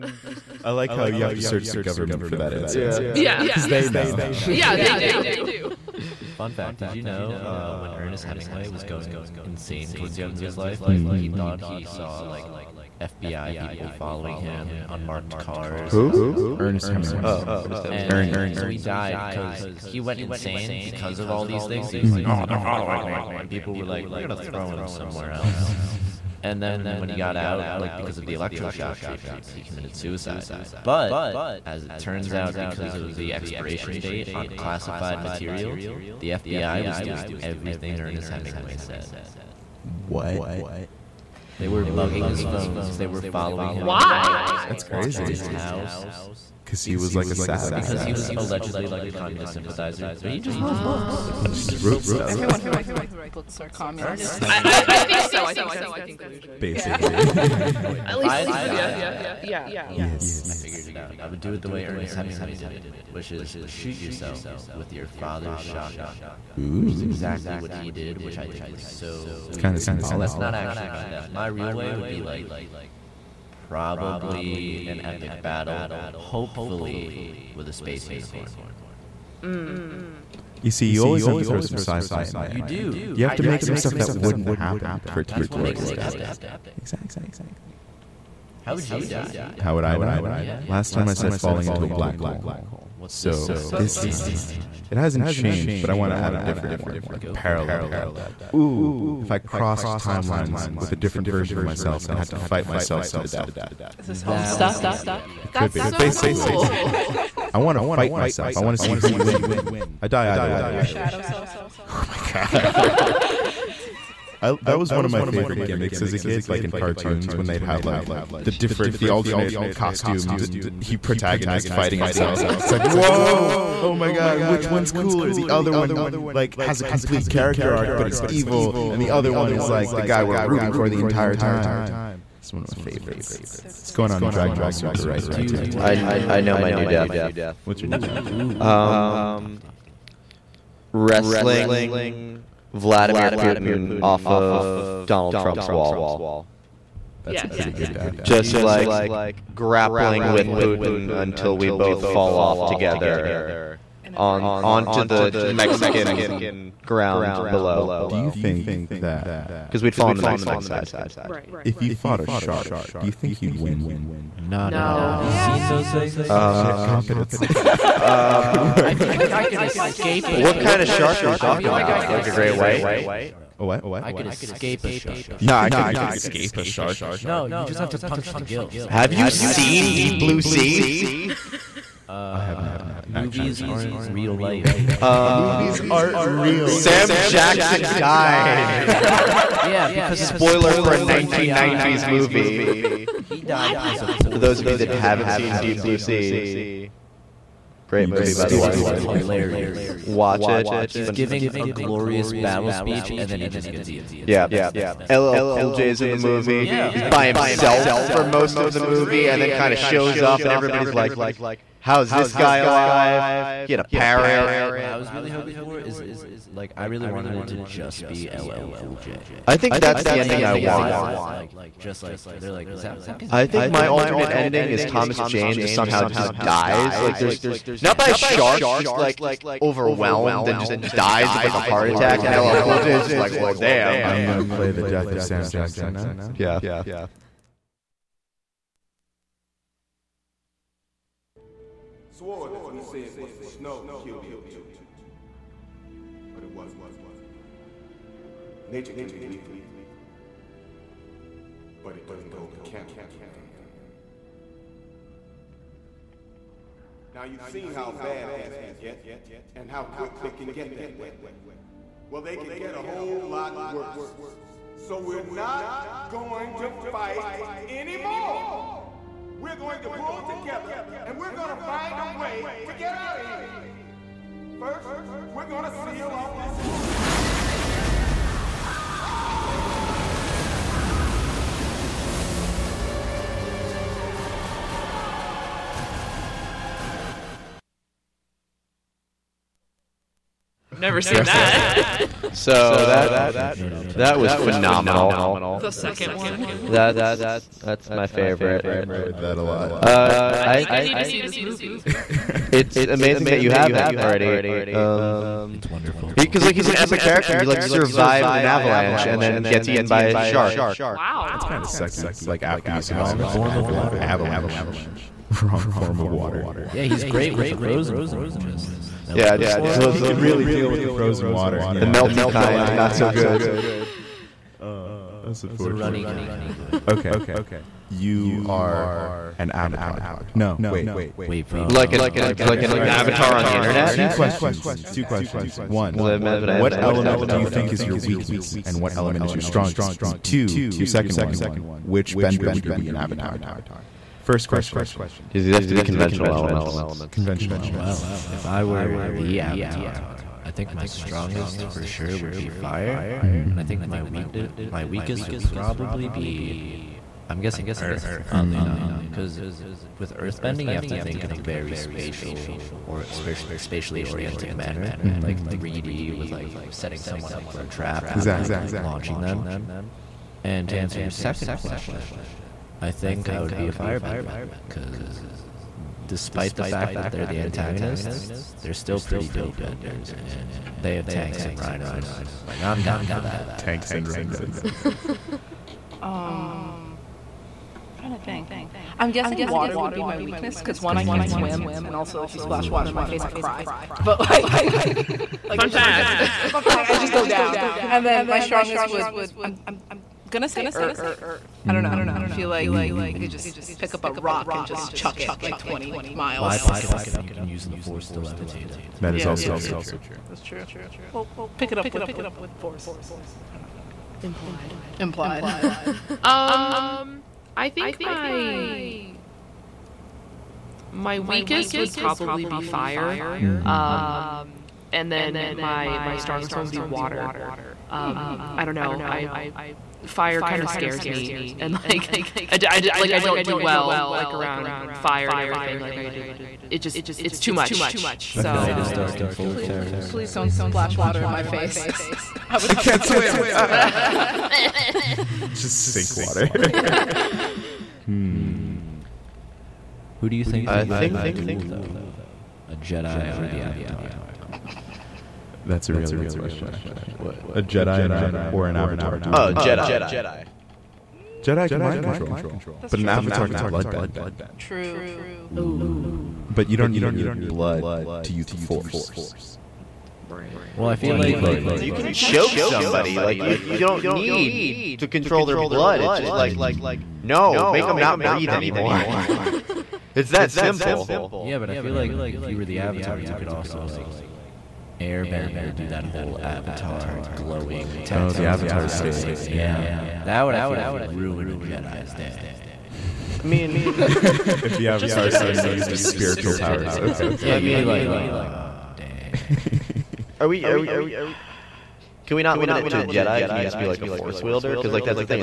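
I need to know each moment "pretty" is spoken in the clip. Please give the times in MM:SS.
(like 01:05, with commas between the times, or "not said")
02:27, 06:19.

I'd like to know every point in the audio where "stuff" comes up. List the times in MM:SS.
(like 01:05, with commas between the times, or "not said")
00:52, 01:23.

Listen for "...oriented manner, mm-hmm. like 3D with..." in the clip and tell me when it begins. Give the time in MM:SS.
06:04.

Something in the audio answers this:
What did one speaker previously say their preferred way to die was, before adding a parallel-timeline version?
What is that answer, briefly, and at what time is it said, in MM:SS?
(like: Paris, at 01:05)
falling into a black hole, at 01:31.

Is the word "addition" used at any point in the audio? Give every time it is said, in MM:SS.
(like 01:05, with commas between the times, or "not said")
not said.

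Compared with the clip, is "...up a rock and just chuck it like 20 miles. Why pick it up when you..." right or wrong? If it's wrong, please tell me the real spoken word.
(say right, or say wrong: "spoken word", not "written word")
right.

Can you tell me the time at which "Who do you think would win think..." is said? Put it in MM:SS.
07:30.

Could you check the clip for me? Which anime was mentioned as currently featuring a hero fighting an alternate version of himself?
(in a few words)
Dragon Ball Super.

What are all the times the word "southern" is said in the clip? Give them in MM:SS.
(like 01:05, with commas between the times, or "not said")
not said.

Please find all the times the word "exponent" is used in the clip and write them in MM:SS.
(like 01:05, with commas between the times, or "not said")
not said.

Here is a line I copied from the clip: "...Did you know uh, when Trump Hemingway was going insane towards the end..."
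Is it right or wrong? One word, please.
wrong.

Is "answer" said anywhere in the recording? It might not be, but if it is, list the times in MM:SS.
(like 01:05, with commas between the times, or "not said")
00:02, 06:10.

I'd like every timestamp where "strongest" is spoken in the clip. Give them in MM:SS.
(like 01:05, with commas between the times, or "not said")
05:39, 05:50, 06:38, 07:06.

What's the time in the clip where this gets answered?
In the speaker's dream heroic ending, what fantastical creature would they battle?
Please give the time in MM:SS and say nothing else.
01:17.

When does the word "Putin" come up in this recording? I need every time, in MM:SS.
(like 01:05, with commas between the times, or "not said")
02:23, 02:30.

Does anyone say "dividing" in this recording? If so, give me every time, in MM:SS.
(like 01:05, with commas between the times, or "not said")
not said.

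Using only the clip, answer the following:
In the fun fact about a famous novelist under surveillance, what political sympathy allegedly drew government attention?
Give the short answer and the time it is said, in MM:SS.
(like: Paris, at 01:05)
communist, at 00:49.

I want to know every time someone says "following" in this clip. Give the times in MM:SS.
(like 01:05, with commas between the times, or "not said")
00:13, 00:22, 00:43.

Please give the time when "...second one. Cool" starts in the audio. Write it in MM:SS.
04:55.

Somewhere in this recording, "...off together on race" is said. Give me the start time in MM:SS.
02:32.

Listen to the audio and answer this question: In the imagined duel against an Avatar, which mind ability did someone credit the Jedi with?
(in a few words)
mind control.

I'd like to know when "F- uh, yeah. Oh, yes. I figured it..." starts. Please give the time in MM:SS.
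00:59.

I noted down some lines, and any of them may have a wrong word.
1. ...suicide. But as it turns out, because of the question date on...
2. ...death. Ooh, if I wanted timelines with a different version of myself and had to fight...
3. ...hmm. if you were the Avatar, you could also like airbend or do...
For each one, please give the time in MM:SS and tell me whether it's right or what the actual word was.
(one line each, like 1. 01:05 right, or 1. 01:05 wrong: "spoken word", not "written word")
1. 00:29 wrong: "expiration", not "question"
2. 01:37 wrong: "crossed", not "wanted"
3. 08:02 right.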